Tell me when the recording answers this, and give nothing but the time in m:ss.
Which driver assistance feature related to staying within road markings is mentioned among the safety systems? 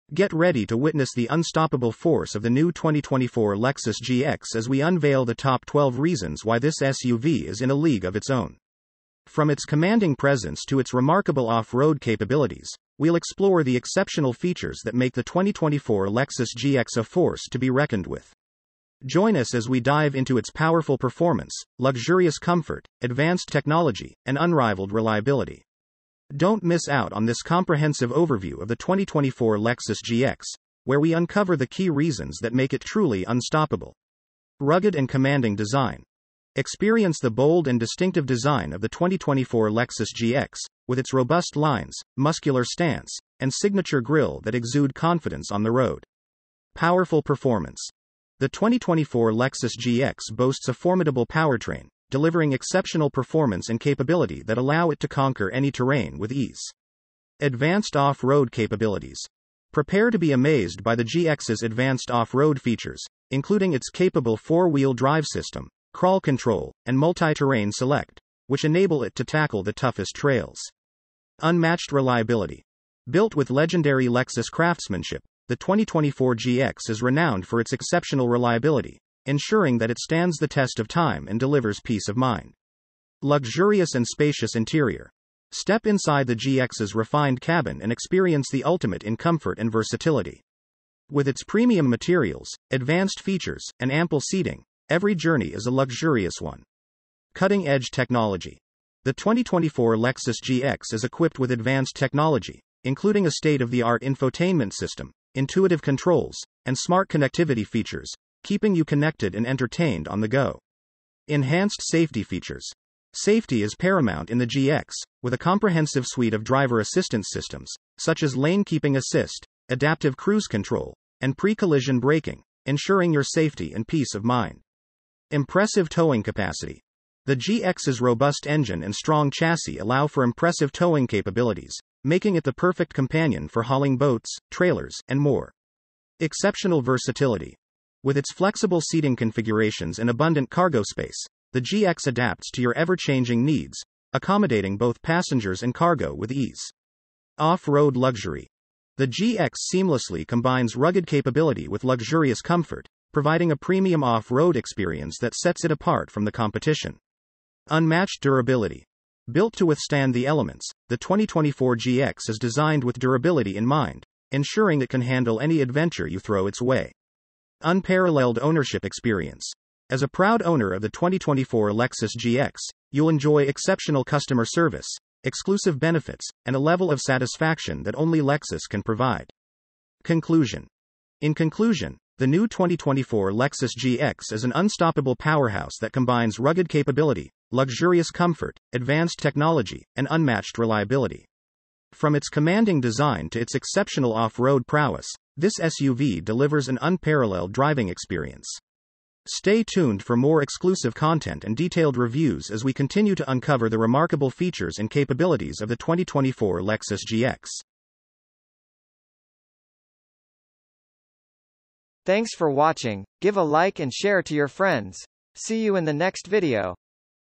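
1:58.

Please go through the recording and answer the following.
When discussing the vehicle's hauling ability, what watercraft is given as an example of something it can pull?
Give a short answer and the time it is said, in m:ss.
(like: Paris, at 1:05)
Boats, at 2:13.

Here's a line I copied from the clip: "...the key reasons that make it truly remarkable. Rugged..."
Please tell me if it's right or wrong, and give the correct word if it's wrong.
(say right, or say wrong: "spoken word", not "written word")
wrong: "unstoppable", not "remarkable".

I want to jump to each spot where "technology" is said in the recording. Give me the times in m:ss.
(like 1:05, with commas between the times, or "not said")
0:23, 1:37, 1:41, 3:09.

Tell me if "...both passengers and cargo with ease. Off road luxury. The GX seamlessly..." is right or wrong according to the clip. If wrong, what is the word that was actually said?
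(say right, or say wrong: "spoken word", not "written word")
right.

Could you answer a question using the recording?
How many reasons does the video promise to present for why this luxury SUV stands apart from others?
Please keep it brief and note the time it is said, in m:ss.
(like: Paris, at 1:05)
12, at 0:05.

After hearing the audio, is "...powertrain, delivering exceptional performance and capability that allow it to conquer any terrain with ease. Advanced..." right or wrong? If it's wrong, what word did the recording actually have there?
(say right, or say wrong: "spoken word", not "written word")
right.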